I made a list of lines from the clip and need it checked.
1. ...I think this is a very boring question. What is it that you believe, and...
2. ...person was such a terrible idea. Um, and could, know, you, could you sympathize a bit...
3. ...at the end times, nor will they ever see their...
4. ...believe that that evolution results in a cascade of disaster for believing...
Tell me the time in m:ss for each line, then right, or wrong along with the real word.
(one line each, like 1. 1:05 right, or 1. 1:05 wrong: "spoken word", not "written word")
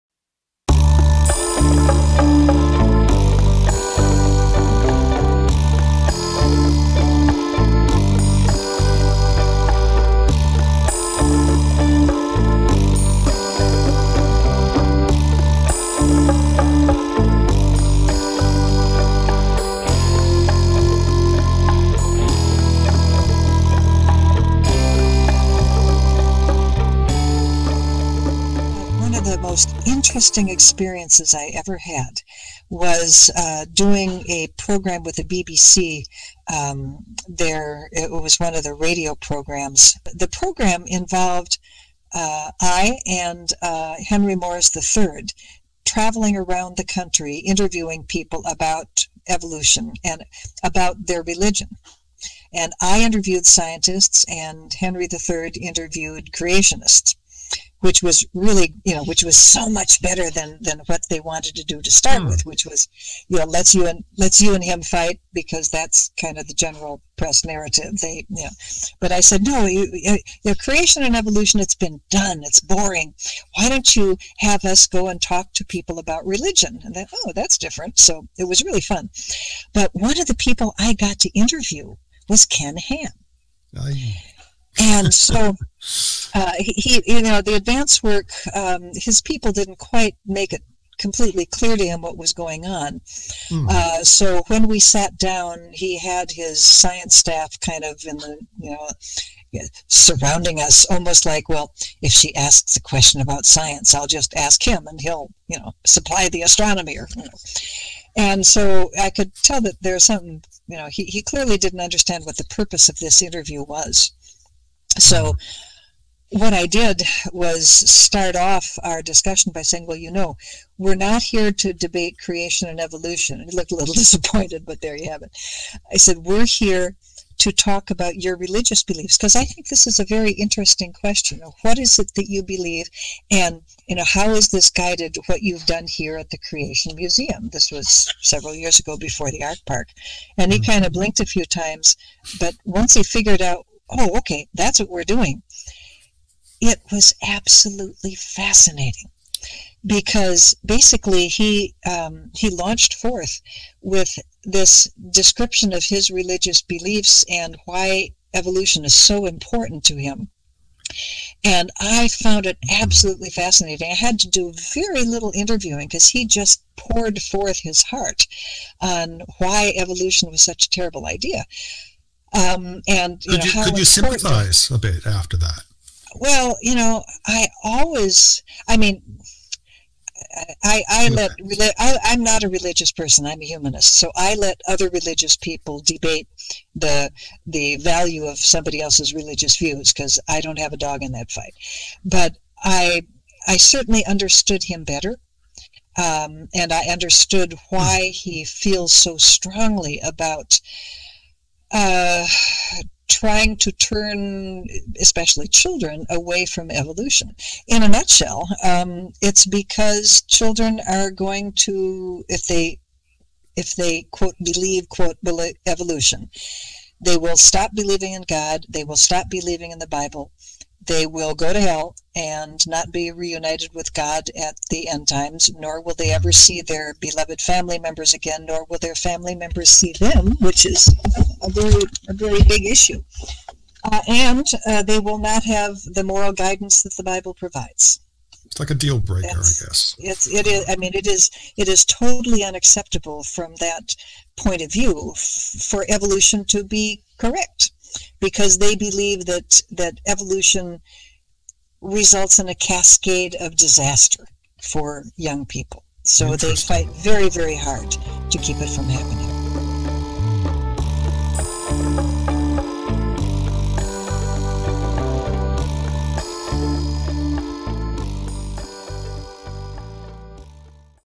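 1. 2:09 wrong: "interesting", not "boring"
2. 2:49 wrong: "evolution", not "person"
3. 3:44 right
4. 4:08 wrong: "young", not "believing".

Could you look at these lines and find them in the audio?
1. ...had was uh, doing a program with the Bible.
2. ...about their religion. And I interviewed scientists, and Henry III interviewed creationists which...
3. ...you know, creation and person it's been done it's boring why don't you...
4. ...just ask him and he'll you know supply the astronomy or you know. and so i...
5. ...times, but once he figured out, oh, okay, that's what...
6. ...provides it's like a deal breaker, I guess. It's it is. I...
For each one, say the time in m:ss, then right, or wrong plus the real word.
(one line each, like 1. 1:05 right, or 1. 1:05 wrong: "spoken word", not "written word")
1. 0:31 wrong: "BBC", not "Bible"
2. 0:50 right
3. 1:09 wrong: "evolution", not "person"
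4. 1:44 right
5. 2:21 right
6. 3:57 right.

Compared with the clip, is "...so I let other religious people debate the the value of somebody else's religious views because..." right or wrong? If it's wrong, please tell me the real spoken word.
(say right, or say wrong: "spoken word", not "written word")
right.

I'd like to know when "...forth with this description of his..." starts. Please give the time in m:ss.
2:32.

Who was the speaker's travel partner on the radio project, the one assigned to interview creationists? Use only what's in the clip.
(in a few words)
Henry Morris III.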